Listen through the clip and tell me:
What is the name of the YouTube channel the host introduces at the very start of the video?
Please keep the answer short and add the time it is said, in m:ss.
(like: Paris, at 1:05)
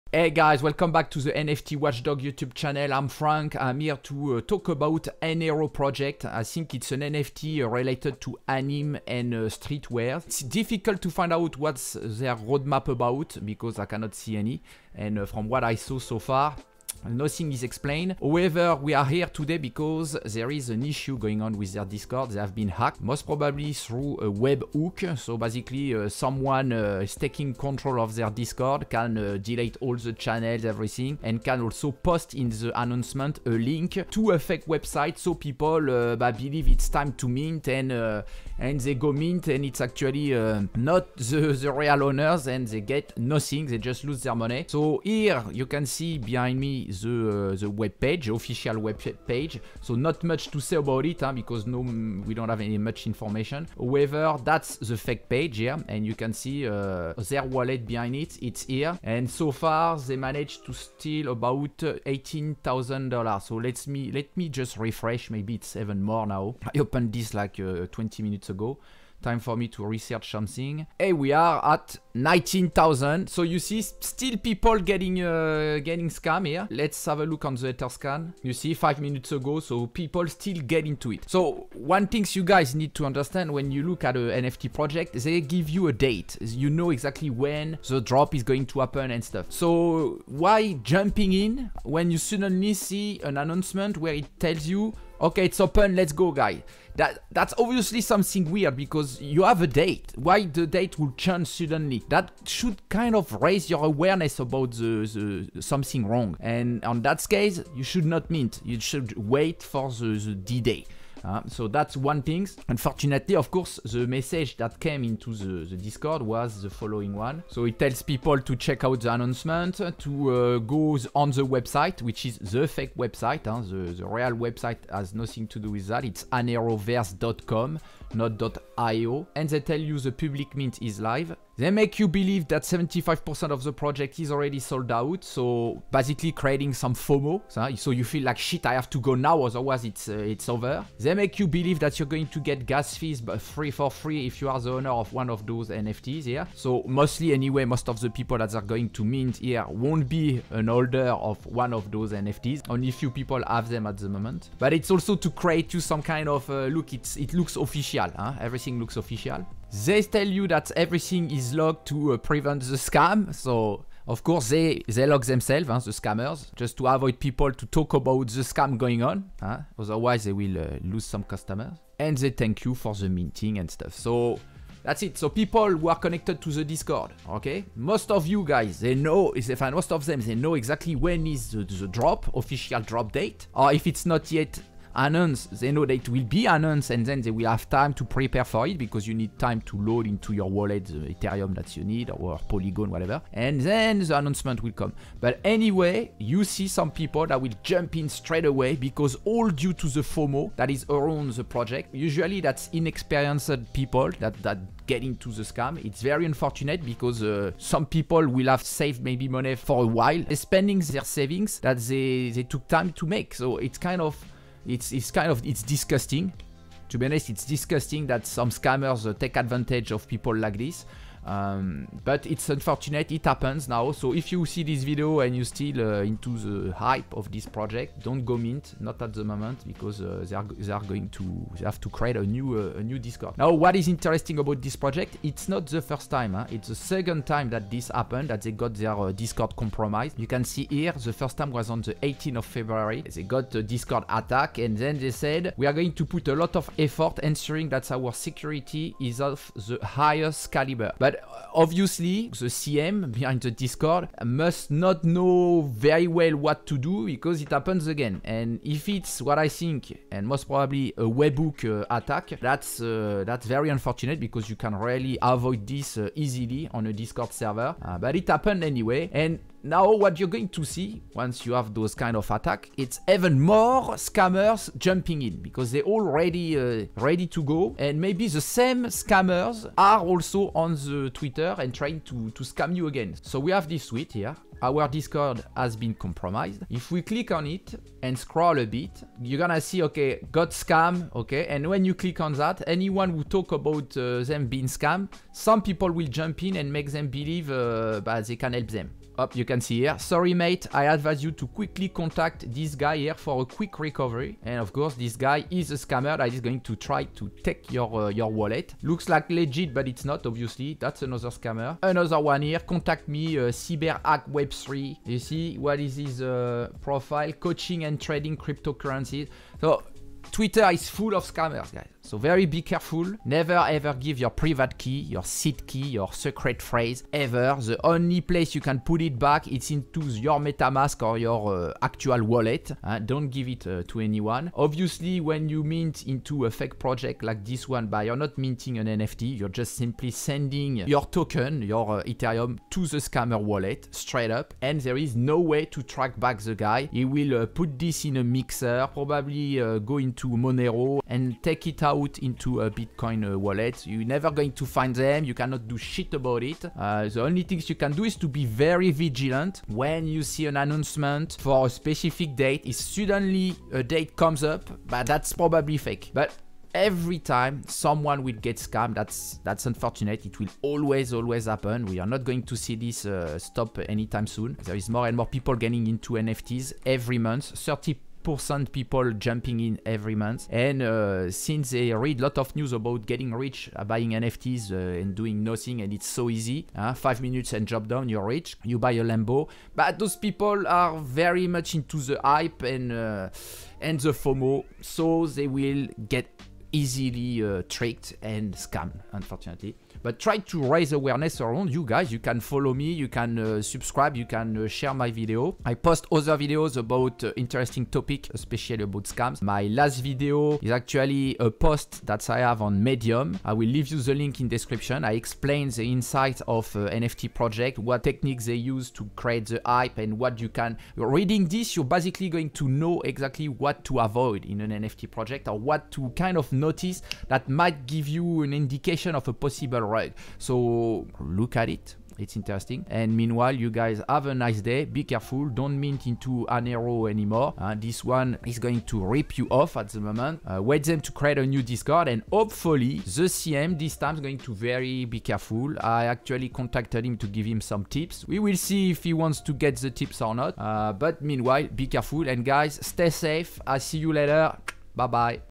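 NFT Watchdog, at 0:01.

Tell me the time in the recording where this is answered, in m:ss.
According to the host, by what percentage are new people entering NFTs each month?
6:17.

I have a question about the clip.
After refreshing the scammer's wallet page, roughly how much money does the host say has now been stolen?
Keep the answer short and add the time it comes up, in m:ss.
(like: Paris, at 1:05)
19,000, at 1:12.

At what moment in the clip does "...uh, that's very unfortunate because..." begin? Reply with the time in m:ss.
4:22.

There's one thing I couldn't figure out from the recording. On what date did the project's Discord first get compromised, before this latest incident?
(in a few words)
18th of February.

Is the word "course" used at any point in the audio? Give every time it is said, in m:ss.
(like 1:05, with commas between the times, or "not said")
1:53, 2:44, 5:04.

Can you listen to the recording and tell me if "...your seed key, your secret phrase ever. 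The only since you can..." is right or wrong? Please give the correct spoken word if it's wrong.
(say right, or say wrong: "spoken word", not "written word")
wrong: "place", not "since".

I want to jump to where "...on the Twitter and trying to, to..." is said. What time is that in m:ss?
4:40.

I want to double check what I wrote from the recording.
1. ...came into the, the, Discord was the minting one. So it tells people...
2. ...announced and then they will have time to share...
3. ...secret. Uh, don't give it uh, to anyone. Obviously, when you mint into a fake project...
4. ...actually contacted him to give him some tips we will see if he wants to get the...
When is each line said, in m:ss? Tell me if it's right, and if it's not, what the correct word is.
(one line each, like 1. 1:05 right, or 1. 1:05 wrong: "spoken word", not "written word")
1. 1:54 wrong: "following", not "minting"
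2. 3:06 wrong: "prepare", not "share"
3. 5:32 wrong: "wallet", not "secret"
4. 7:26 right.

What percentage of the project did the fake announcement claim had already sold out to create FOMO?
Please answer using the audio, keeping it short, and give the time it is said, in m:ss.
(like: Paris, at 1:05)
75%, at 2:12.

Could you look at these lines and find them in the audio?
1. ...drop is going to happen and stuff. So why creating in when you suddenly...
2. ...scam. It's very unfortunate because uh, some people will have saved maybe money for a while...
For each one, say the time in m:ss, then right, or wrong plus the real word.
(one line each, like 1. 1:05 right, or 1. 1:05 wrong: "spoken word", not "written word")
1. 1:28 wrong: "jumping", not "creating"
2. 3:25 right.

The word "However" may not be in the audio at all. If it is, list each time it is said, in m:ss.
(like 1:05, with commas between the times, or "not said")
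0:18, 0:53.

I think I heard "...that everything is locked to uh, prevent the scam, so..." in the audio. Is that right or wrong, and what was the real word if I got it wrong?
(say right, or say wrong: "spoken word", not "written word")
right.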